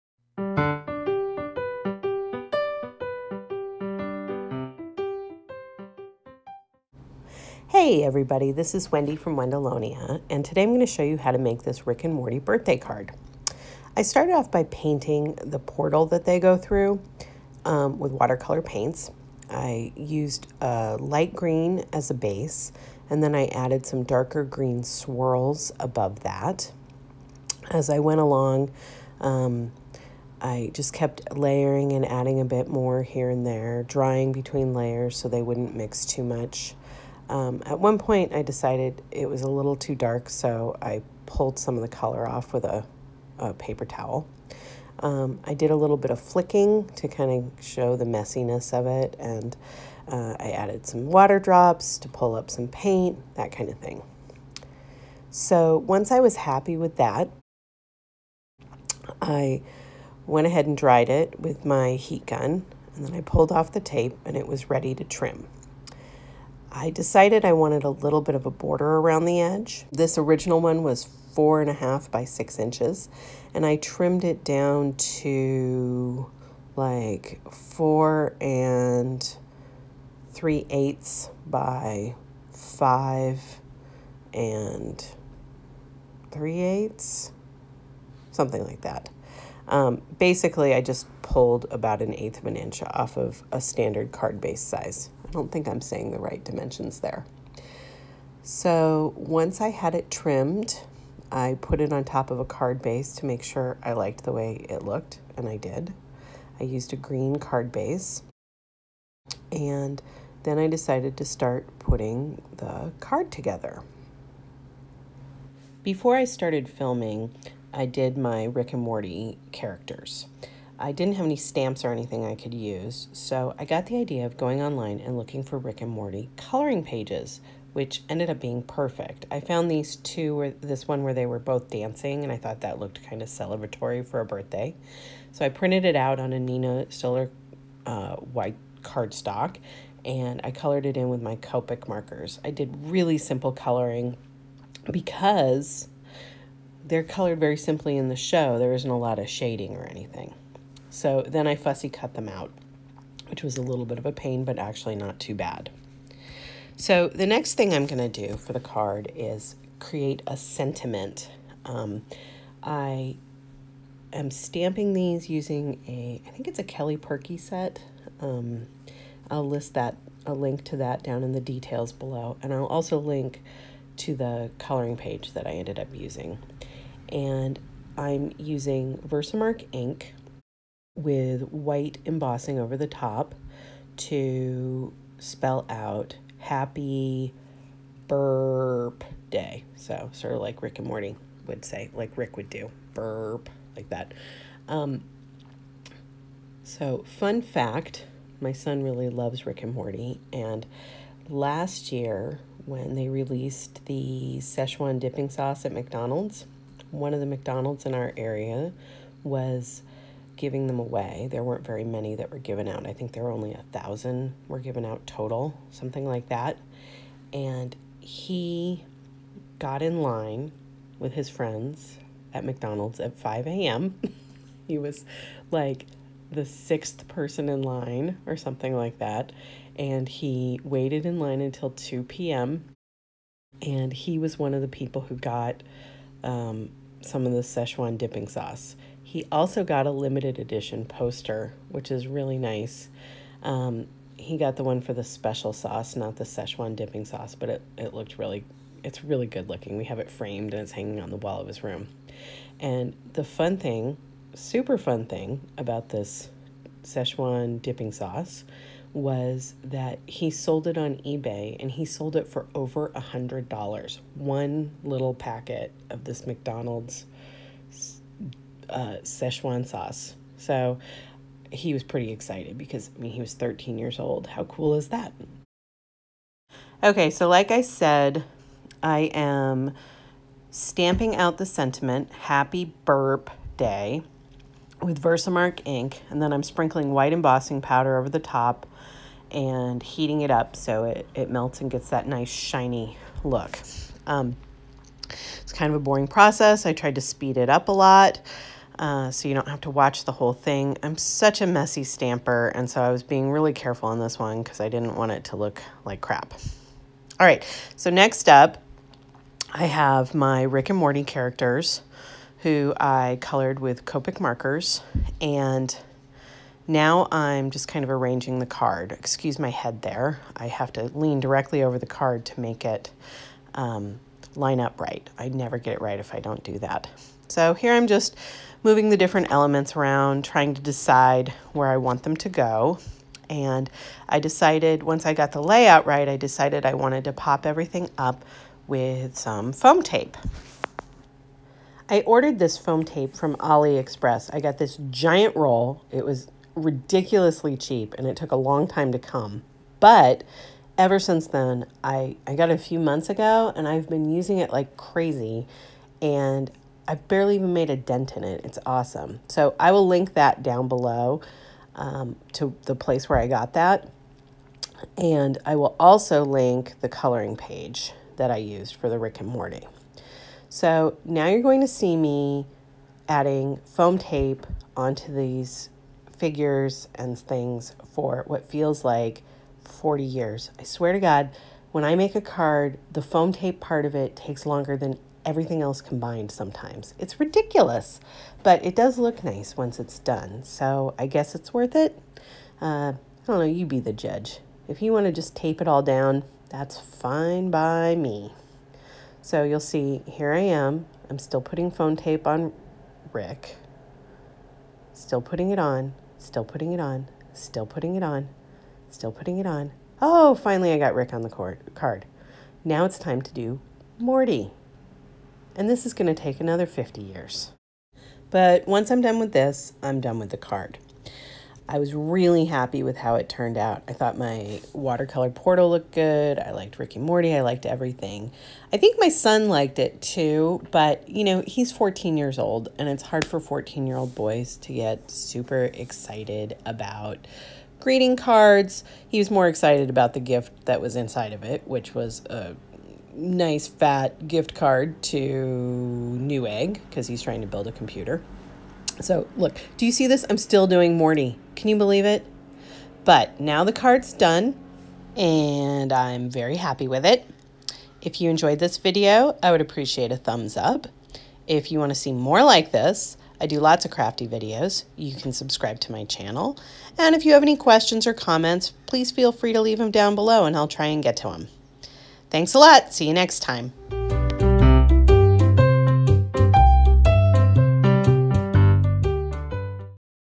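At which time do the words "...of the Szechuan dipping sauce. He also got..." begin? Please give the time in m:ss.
3:57.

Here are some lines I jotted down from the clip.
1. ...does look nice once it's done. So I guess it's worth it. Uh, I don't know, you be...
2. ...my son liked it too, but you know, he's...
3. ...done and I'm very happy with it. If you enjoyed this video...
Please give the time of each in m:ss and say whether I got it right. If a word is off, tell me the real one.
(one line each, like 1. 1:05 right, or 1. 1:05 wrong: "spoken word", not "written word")
1. 6:28 right
2. 7:08 right
3. 7:34 right.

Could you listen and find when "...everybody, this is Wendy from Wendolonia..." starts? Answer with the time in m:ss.
0:08.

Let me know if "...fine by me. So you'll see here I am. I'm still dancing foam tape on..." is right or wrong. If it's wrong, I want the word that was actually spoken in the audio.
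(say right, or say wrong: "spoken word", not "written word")
wrong: "putting", not "dancing".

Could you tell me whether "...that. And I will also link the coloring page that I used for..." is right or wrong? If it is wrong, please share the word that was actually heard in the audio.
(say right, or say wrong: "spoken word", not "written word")
right.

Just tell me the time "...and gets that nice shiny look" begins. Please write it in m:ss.
4:51.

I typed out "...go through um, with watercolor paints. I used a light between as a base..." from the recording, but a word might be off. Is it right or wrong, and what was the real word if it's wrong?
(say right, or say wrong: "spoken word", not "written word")
wrong: "green", not "between".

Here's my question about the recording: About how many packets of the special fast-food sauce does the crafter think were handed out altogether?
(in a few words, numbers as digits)
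1000.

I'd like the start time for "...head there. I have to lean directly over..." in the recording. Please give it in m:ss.
5:19.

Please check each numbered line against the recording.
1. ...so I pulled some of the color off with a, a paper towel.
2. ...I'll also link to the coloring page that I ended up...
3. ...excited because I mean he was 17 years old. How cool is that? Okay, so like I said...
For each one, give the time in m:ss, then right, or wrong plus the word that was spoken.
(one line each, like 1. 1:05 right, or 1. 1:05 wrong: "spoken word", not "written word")
1. 0:40 right
2. 2:52 right
3. 4:32 wrong: "13", not "17".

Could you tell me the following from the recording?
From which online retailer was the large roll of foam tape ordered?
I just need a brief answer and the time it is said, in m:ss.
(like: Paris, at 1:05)
AliExpress, at 5:43.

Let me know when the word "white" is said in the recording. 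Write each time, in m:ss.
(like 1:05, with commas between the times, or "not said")
2:18, 3:01, 4:46.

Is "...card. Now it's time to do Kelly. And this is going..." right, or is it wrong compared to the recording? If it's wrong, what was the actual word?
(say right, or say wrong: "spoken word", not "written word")
wrong: "Morty", not "Kelly".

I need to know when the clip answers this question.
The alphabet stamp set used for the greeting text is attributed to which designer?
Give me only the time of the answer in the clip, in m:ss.
2:46.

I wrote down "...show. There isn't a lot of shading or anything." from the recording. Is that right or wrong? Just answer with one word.
right.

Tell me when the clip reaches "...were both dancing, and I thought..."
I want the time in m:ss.
2:11.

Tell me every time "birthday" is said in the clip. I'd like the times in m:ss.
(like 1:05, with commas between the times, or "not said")
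0:12, 2:14.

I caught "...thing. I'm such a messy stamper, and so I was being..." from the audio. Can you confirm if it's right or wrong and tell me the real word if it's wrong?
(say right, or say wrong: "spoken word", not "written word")
right.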